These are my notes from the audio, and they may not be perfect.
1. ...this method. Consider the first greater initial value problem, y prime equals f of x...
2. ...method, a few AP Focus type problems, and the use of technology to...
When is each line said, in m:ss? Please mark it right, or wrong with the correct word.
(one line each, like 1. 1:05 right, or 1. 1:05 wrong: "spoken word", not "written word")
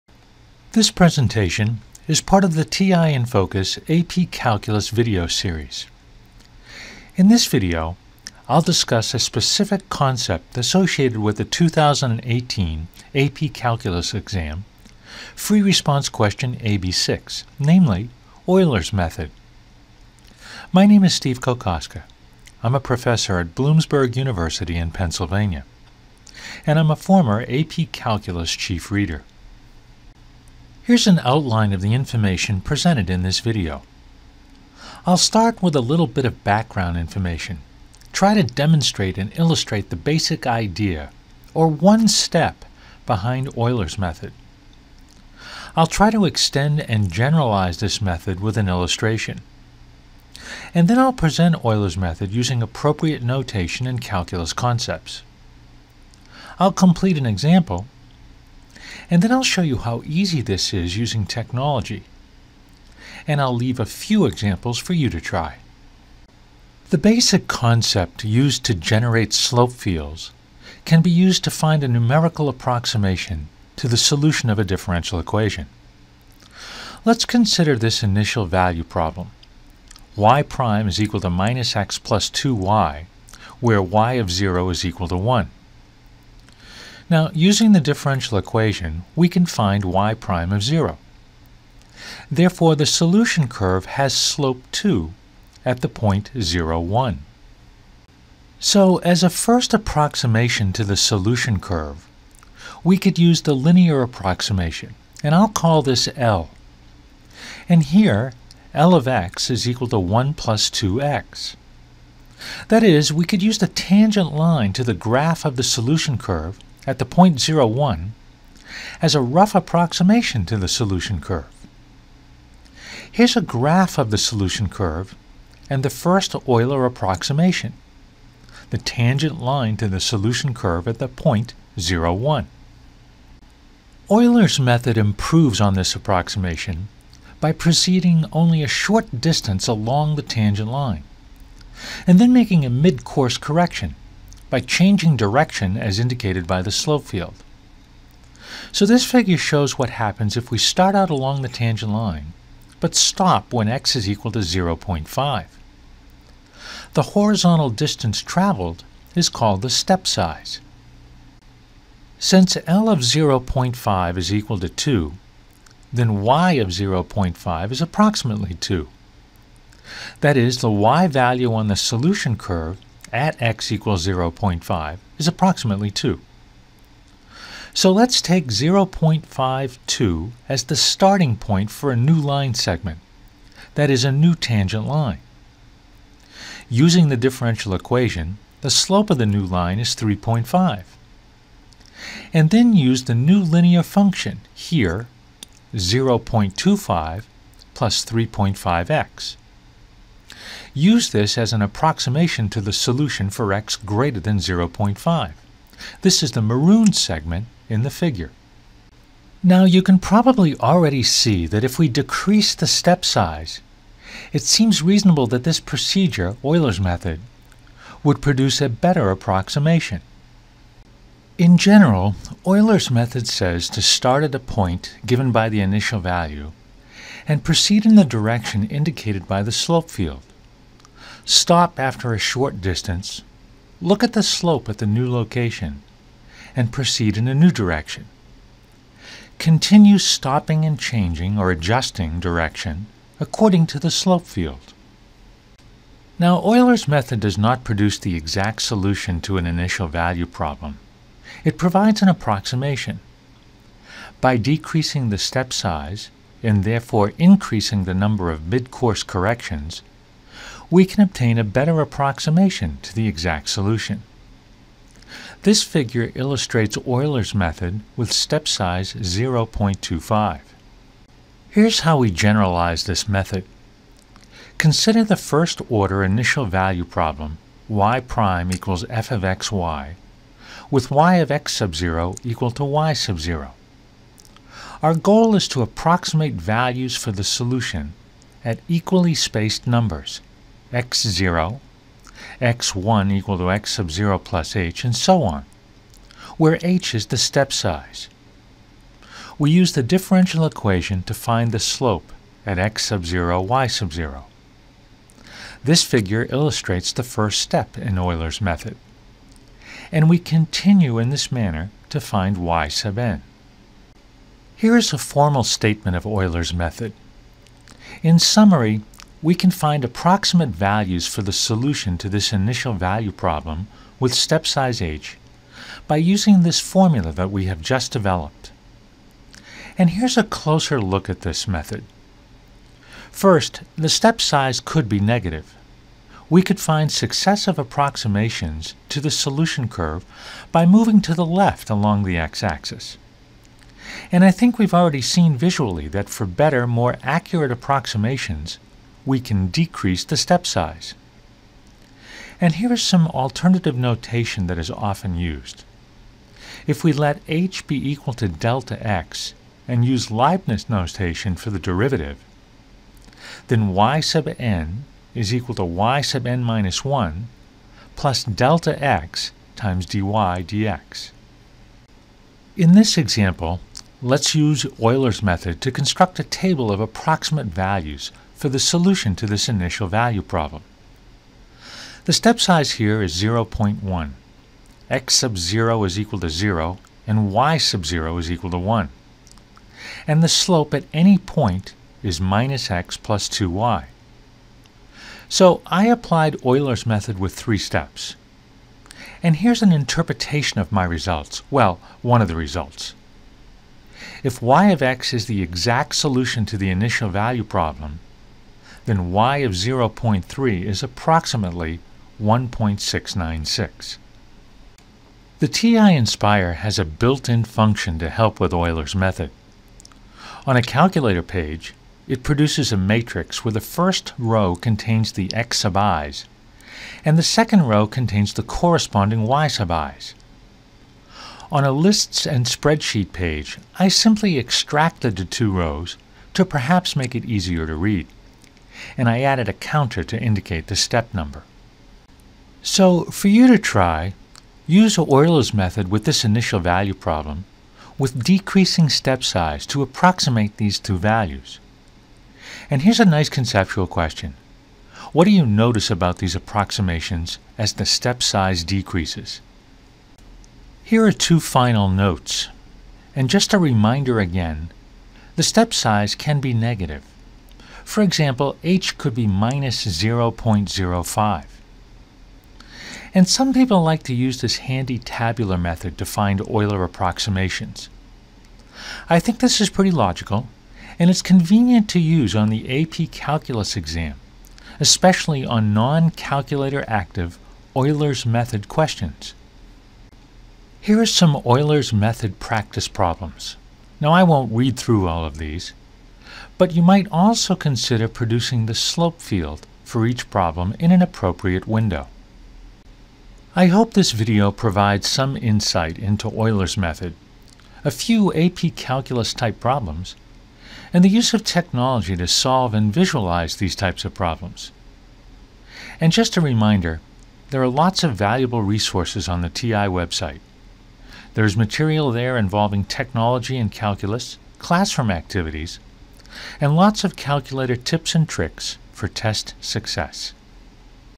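1. 4:32 wrong: "order", not "greater"
2. 8:26 wrong: "Calculus", not "Focus".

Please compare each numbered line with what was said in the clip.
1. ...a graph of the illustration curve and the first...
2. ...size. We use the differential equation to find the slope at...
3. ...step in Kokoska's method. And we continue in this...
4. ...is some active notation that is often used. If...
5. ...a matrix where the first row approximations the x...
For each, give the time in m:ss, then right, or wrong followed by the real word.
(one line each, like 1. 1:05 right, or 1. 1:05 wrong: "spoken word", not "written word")
1. 2:03 wrong: "solution", not "illustration"
2. 4:57 right
3. 5:07 wrong: "Euler", not "Kokoska"
4. 5:52 wrong: "alternative", not "active"
5. 7:02 wrong: "contains", not "approximations".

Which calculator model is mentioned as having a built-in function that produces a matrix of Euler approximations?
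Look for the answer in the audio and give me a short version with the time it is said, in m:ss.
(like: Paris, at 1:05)
TI Nspire, at 6:55.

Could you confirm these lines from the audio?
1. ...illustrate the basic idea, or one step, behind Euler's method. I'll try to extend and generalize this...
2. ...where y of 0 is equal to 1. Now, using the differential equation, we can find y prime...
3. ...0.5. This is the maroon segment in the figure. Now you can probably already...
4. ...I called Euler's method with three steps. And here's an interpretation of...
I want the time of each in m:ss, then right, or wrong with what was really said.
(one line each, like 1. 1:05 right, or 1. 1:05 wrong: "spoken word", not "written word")
1. 0:39 right
2. 1:23 right
3. 3:24 right
4. 6:35 wrong: "applied", not "called".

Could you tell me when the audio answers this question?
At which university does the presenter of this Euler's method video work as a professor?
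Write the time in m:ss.
0:23.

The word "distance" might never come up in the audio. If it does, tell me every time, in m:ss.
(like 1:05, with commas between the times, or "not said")
2:19, 2:37, 3:52.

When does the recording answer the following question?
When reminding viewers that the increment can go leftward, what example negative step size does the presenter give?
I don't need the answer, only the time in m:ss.
7:49.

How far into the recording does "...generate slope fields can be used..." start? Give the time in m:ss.
1:08.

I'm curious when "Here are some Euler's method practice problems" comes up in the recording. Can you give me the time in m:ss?
8:10.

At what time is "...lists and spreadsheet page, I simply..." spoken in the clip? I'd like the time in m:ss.
7:11.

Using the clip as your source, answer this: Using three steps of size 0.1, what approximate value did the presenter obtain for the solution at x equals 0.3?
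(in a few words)
1.696.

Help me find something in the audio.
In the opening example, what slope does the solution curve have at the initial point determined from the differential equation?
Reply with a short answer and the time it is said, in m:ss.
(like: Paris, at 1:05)
2, at 1:34.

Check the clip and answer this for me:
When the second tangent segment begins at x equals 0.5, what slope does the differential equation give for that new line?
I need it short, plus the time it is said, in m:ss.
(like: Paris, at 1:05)
3.5, at 3:09.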